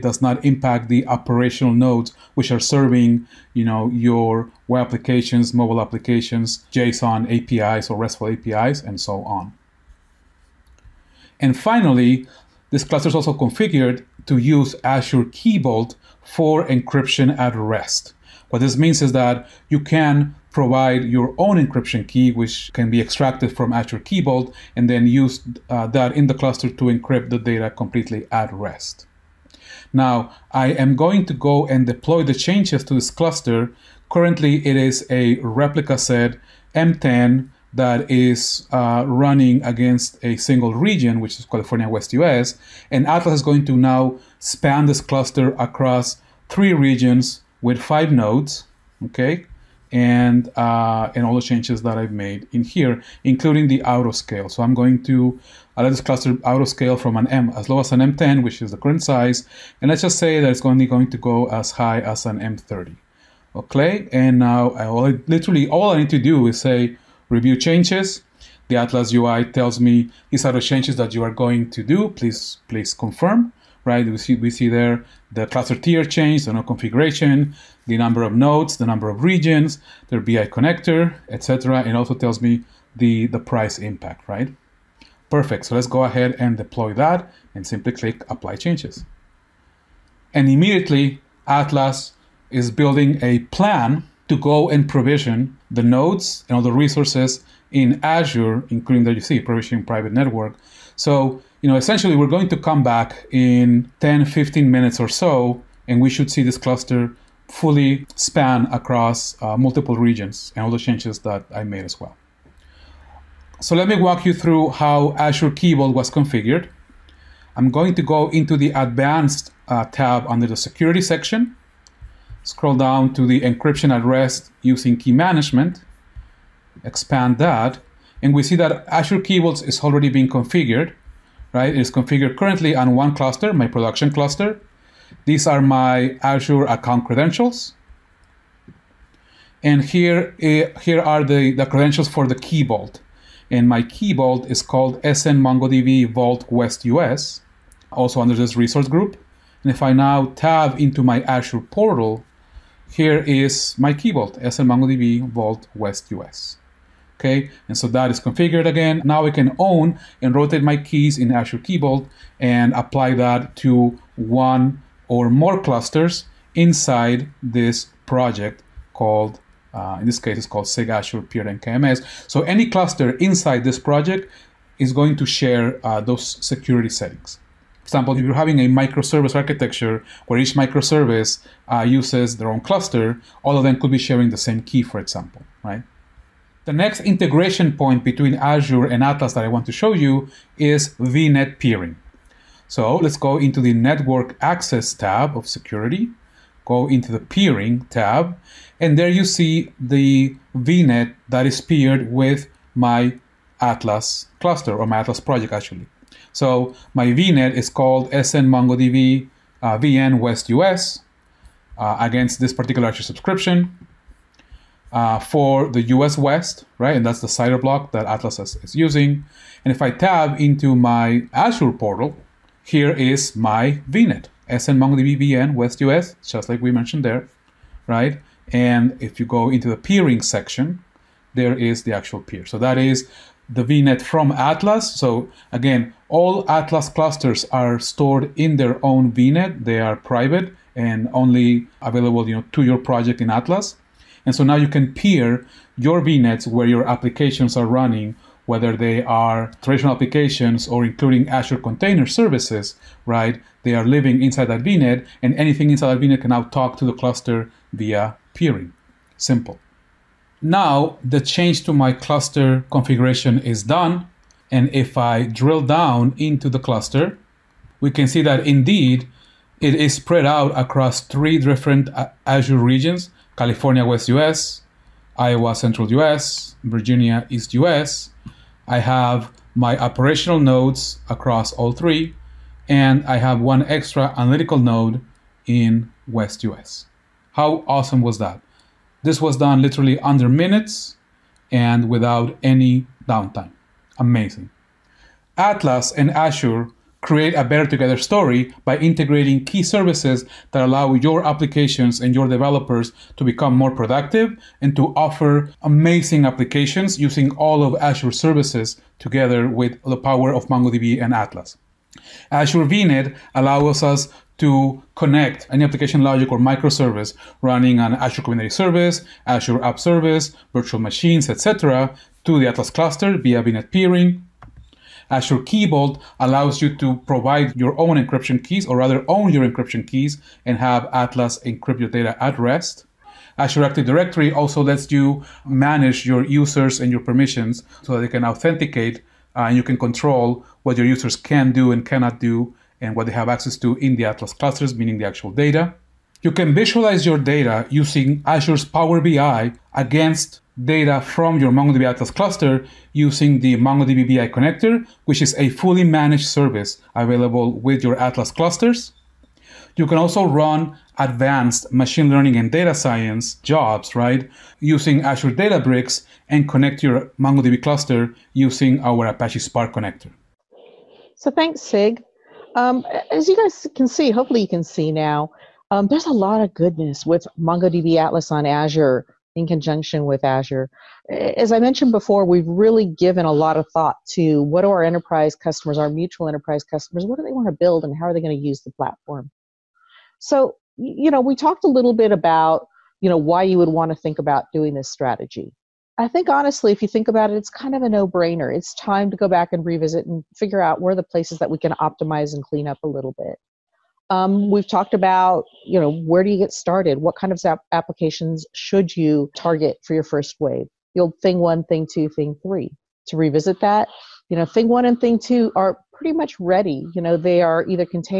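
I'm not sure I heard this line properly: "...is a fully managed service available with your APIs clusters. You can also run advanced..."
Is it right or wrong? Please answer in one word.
wrong.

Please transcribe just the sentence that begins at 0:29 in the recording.
Now, I am going to go and deploy the changes to this cluster.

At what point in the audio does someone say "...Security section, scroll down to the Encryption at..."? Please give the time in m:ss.
2:00.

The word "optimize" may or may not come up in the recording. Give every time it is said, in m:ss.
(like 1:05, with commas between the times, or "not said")
6:41.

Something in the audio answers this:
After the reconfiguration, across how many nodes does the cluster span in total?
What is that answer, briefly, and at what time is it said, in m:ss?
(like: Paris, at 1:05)
5, at 0:47.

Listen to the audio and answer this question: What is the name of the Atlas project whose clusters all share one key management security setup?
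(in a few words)
SIG Azure Peer KMS.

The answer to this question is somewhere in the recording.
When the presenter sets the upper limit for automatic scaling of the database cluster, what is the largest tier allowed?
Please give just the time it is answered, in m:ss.
1:02.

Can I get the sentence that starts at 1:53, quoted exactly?
So let me walk you through how Azure Key Vault was configured.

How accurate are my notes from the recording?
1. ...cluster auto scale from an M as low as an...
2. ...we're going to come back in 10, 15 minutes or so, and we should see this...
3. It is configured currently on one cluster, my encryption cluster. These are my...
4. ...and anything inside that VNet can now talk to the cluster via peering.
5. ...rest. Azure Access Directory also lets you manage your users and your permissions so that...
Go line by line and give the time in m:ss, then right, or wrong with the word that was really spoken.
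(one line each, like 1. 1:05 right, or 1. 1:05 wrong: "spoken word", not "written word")
1. 0:56 right
2. 1:42 right
3. 2:11 wrong: "production", not "encryption"
4. 4:15 right
5. 5:32 wrong: "Active", not "Access".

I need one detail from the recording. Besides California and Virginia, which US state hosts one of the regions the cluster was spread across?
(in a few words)
Iowa.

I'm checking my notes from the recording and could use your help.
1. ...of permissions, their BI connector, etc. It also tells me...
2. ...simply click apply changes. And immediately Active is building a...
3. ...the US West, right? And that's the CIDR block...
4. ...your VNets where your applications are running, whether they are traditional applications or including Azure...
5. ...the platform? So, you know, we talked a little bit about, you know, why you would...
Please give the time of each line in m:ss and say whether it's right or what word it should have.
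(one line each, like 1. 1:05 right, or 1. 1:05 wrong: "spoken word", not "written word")
1. 1:19 wrong: "regions", not "permissions"
2. 1:27 wrong: "Atlas", not "Active"
3. 3:35 right
4. 4:05 right
5. 6:28 right.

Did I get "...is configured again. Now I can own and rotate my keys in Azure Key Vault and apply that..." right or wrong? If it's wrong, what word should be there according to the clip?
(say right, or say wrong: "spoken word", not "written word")
right.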